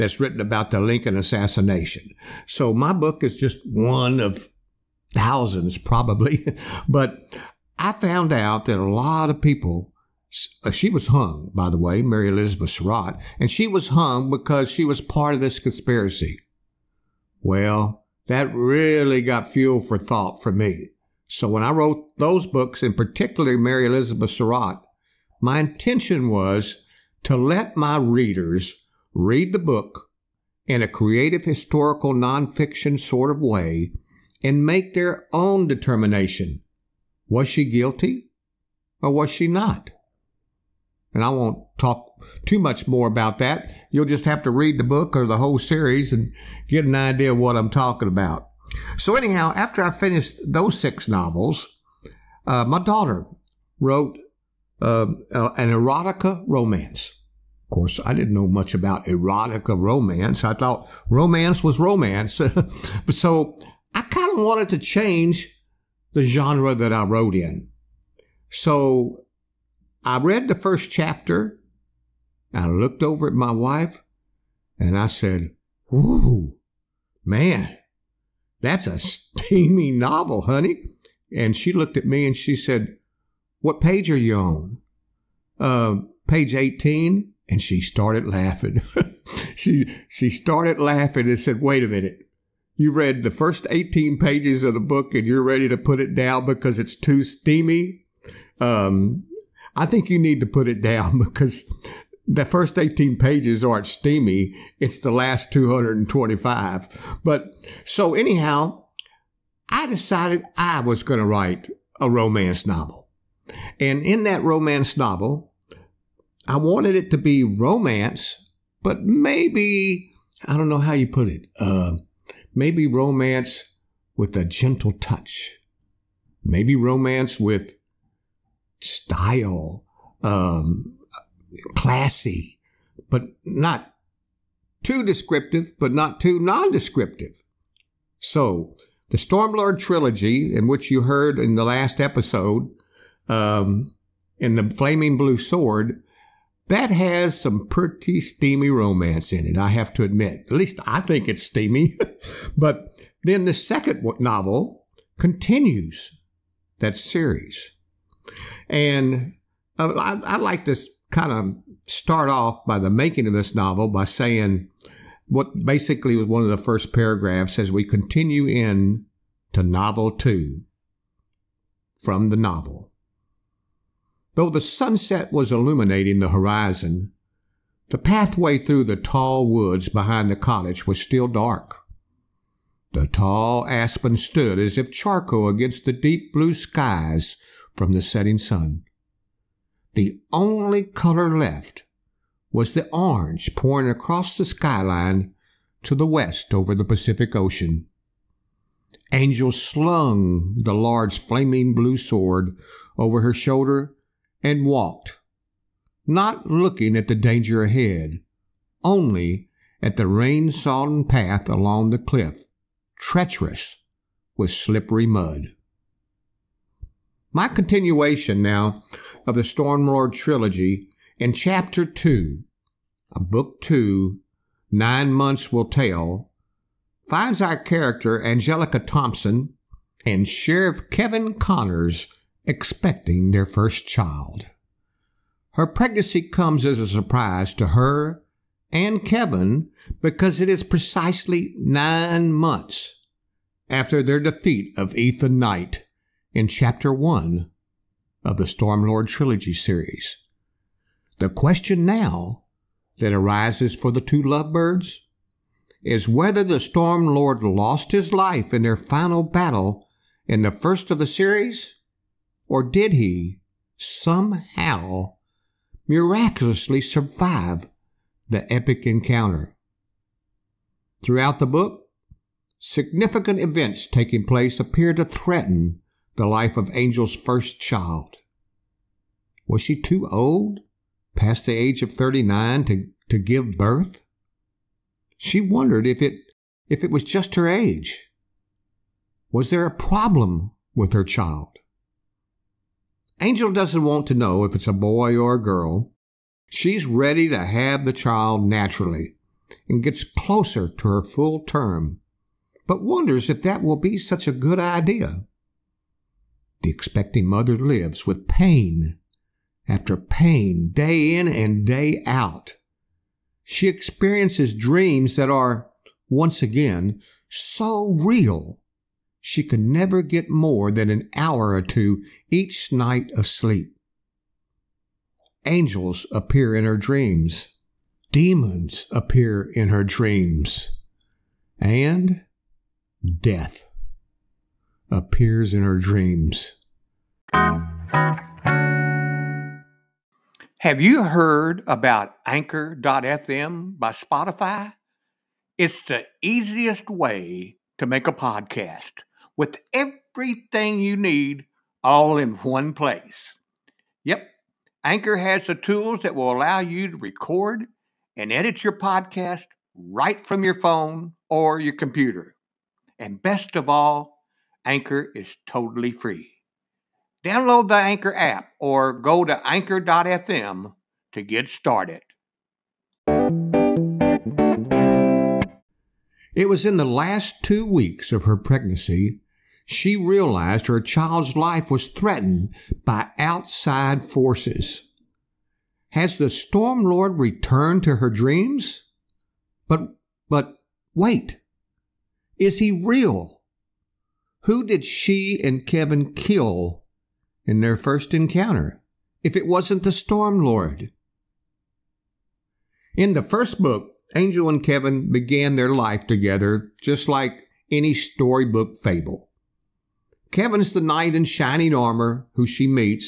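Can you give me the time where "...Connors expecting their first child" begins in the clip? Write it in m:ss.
3:51.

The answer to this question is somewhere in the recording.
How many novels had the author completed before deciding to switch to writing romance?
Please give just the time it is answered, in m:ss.
0:50.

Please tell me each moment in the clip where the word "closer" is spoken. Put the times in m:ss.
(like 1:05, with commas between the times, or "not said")
5:00.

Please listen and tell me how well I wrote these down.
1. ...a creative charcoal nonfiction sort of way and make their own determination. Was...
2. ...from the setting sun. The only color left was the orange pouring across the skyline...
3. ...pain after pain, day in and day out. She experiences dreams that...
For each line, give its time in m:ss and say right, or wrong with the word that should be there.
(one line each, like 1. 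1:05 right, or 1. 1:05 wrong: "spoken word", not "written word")
1. 0:30 wrong: "historical", not "charcoal"
2. 3:07 right
3. 5:08 right.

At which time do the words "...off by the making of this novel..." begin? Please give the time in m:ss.
2:42.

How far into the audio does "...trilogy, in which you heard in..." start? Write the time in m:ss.
2:19.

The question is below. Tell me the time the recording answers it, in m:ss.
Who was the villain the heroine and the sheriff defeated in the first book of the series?
4:04.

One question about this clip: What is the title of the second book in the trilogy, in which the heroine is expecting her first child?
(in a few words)
Nine Months Will Tell.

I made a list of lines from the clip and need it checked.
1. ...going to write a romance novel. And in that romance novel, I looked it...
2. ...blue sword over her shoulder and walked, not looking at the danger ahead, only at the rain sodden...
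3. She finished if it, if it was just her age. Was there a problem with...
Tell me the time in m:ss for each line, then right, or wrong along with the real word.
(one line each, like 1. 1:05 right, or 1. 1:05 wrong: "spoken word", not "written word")
1. 1:51 wrong: "wanted", not "looked"
2. 3:21 right
3. 4:45 wrong: "wondered", not "finished".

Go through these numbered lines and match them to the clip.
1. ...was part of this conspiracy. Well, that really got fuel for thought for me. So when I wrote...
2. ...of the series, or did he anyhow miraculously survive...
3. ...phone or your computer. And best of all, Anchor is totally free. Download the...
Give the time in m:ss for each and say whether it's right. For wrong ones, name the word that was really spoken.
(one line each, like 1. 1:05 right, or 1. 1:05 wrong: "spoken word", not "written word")
1. 0:14 right
2. 4:20 wrong: "somehow", not "anyhow"
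3. 6:00 right.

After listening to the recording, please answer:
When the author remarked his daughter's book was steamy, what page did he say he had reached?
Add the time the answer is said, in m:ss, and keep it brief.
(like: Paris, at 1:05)
18, at 1:26.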